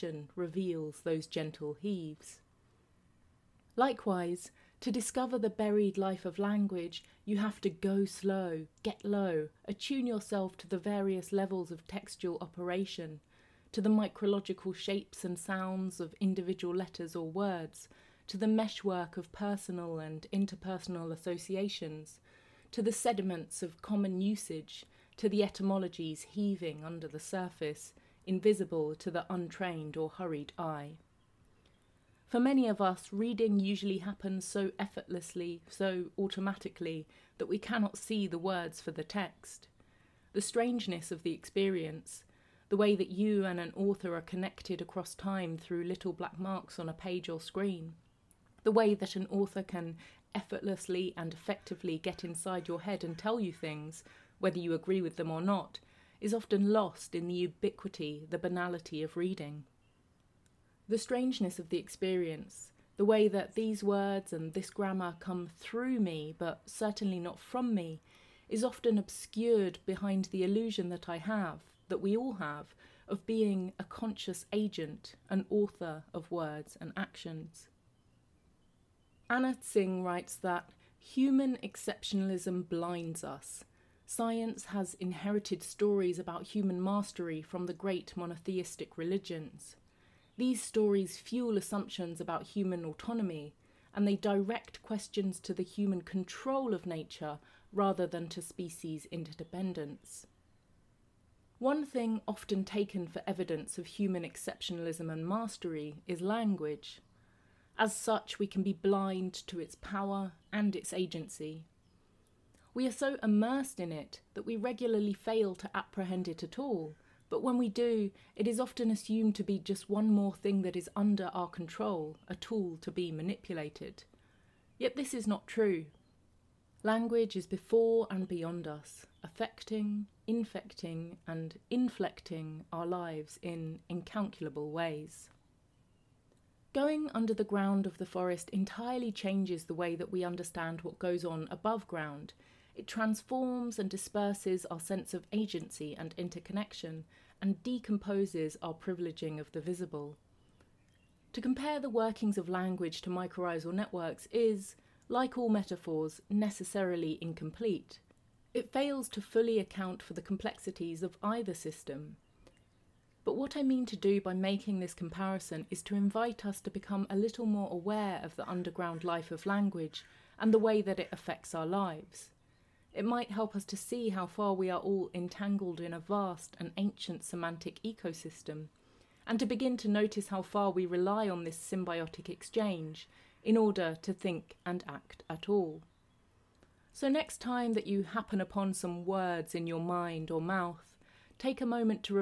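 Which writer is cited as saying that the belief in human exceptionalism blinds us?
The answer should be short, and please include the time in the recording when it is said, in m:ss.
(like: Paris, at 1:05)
Anna Tsing, at 1:19.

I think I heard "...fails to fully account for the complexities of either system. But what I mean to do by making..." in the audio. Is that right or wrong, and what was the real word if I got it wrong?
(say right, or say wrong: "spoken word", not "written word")
right.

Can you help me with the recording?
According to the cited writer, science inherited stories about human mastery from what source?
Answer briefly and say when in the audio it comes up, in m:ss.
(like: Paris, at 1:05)
monotheistic religions, at 1:28.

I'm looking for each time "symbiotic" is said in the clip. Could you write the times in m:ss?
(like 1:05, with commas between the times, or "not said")
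3:01.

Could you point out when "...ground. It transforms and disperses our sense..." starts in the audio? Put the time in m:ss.
2:21.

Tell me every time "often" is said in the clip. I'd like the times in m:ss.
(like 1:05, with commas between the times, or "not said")
0:56, 1:08, 1:42, 1:58.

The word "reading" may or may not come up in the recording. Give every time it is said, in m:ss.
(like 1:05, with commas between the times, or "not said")
0:33, 0:59.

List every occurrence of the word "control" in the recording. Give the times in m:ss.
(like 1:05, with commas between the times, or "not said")
1:36, 2:01.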